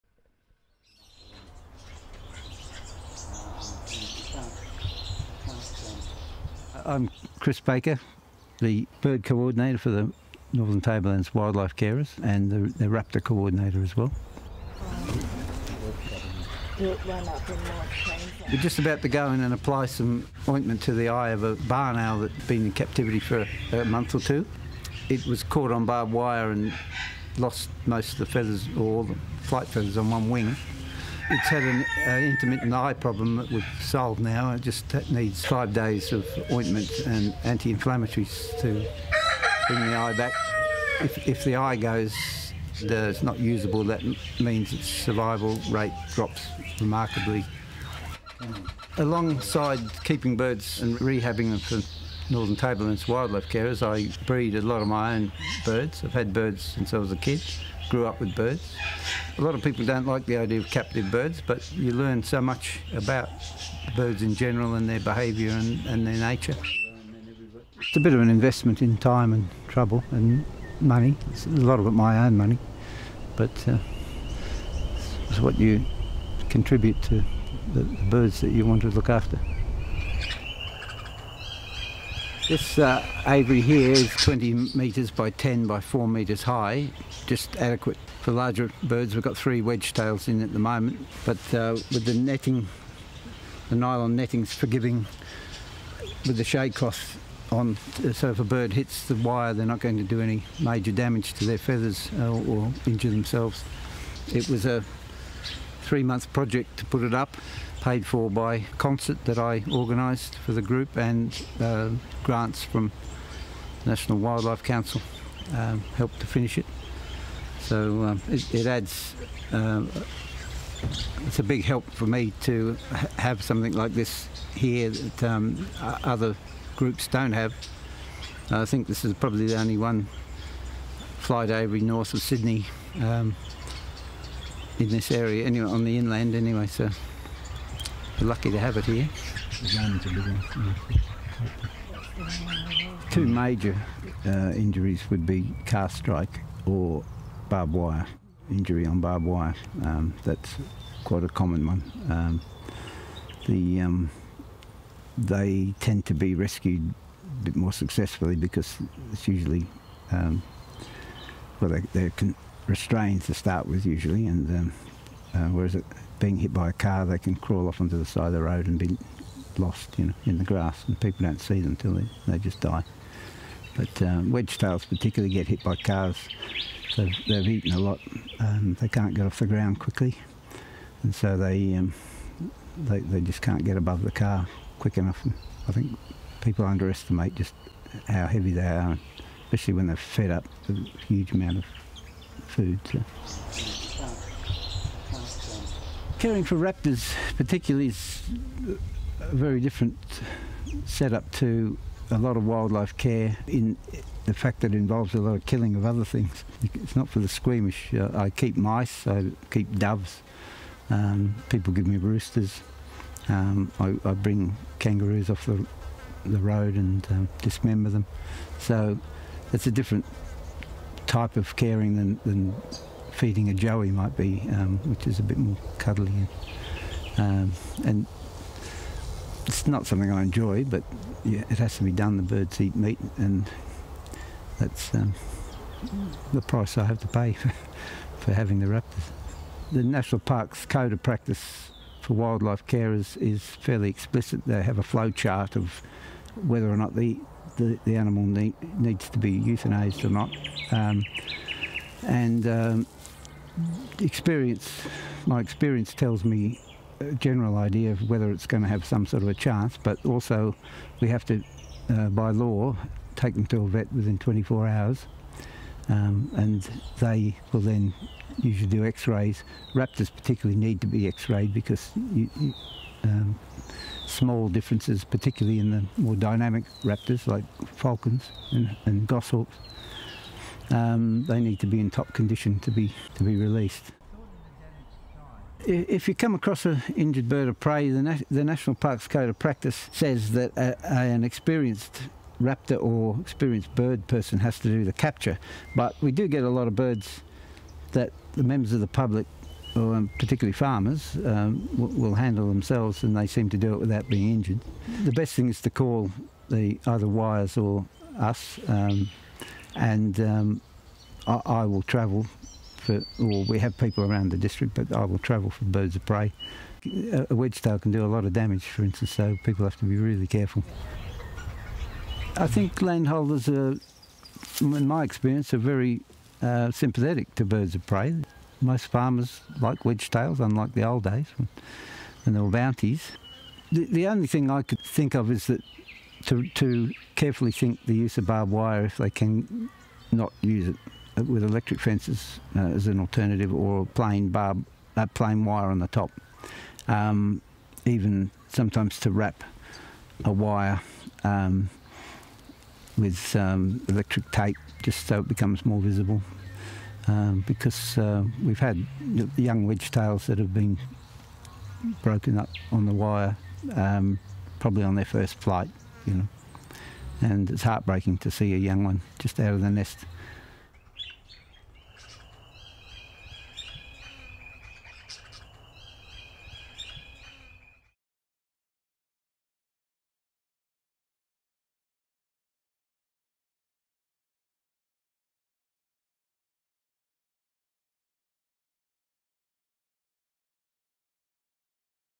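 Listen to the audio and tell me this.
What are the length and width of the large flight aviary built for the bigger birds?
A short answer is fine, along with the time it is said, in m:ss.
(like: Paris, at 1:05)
20 metres by 10, at 1:24.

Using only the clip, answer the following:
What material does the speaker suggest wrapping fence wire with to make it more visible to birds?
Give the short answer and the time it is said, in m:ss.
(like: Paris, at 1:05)
electric tape, at 5:53.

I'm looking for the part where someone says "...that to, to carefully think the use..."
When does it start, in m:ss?
5:35.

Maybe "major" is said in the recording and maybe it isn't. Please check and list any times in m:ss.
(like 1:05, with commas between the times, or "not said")
1:40, 2:23.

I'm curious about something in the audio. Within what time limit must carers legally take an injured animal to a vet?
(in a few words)
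24 hours.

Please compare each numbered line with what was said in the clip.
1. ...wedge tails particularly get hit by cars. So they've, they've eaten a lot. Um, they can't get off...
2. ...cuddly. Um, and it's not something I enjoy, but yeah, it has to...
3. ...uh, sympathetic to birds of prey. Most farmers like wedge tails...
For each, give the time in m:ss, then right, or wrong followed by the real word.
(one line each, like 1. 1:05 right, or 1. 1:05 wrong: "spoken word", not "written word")
1. 2:54 right
2. 3:45 right
3. 5:26 right.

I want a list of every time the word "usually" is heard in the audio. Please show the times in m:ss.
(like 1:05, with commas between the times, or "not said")
2:39, 2:43, 4:28.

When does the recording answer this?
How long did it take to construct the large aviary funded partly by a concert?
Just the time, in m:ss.
1:45.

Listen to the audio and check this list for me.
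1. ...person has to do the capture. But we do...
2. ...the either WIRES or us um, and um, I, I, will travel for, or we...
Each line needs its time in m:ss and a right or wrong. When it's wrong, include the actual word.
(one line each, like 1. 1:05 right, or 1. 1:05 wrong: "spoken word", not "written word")
1. 4:54 right
2. 5:06 right.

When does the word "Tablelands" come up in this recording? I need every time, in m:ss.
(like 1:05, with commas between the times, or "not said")
0:10, 0:52.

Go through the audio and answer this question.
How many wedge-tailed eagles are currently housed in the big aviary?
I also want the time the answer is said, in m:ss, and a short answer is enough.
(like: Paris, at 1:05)
3, at 1:29.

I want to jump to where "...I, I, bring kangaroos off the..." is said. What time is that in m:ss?
3:33.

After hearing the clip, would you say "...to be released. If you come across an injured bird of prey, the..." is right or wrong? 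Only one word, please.
right.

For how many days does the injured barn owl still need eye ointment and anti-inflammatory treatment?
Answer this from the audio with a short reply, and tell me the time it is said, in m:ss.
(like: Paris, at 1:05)
5, at 0:35.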